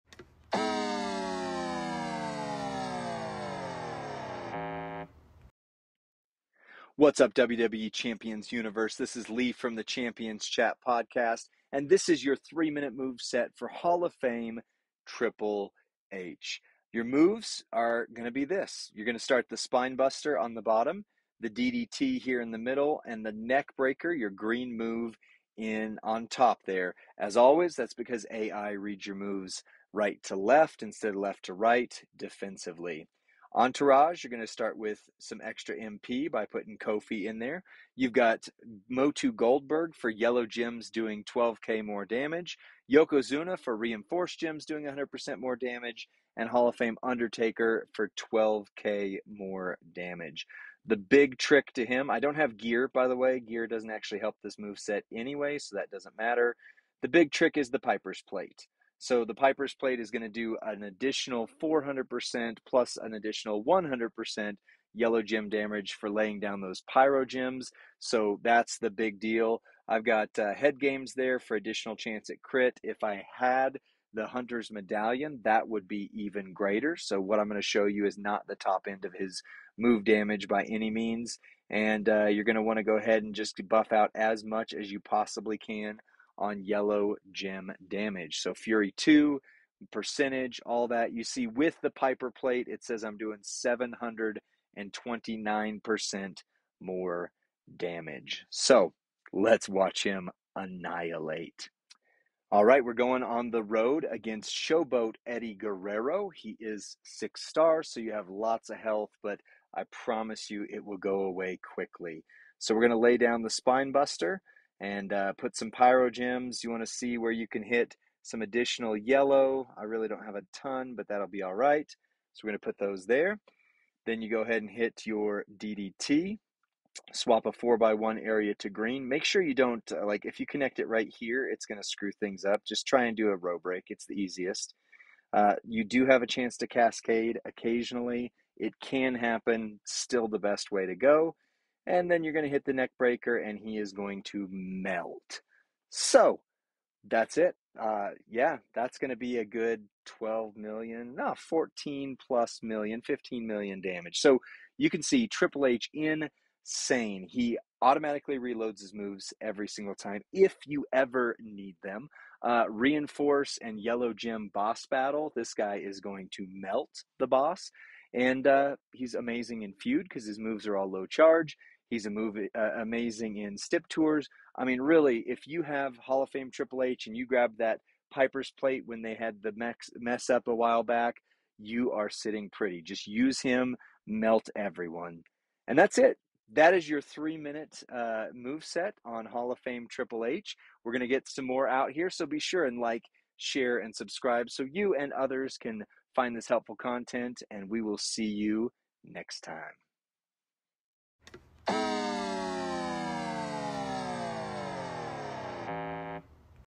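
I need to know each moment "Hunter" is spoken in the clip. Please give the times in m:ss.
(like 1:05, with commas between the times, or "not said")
1:14.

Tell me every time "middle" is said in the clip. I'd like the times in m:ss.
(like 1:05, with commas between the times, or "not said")
0:22.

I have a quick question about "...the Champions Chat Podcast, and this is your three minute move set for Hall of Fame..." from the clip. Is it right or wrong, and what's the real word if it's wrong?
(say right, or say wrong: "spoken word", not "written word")
right.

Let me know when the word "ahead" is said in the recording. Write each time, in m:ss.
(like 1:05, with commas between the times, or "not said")
1:22, 2:04.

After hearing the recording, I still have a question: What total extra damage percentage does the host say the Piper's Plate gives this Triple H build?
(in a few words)
729%.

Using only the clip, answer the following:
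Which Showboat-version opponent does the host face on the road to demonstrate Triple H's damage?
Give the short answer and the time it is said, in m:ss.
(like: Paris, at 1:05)
Eddie Guerrero, at 1:45.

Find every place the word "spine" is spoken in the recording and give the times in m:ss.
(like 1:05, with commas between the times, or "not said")
0:19, 1:53.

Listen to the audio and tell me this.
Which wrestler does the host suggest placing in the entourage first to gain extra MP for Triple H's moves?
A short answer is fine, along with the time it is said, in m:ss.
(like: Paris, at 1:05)
Kofi, at 0:36.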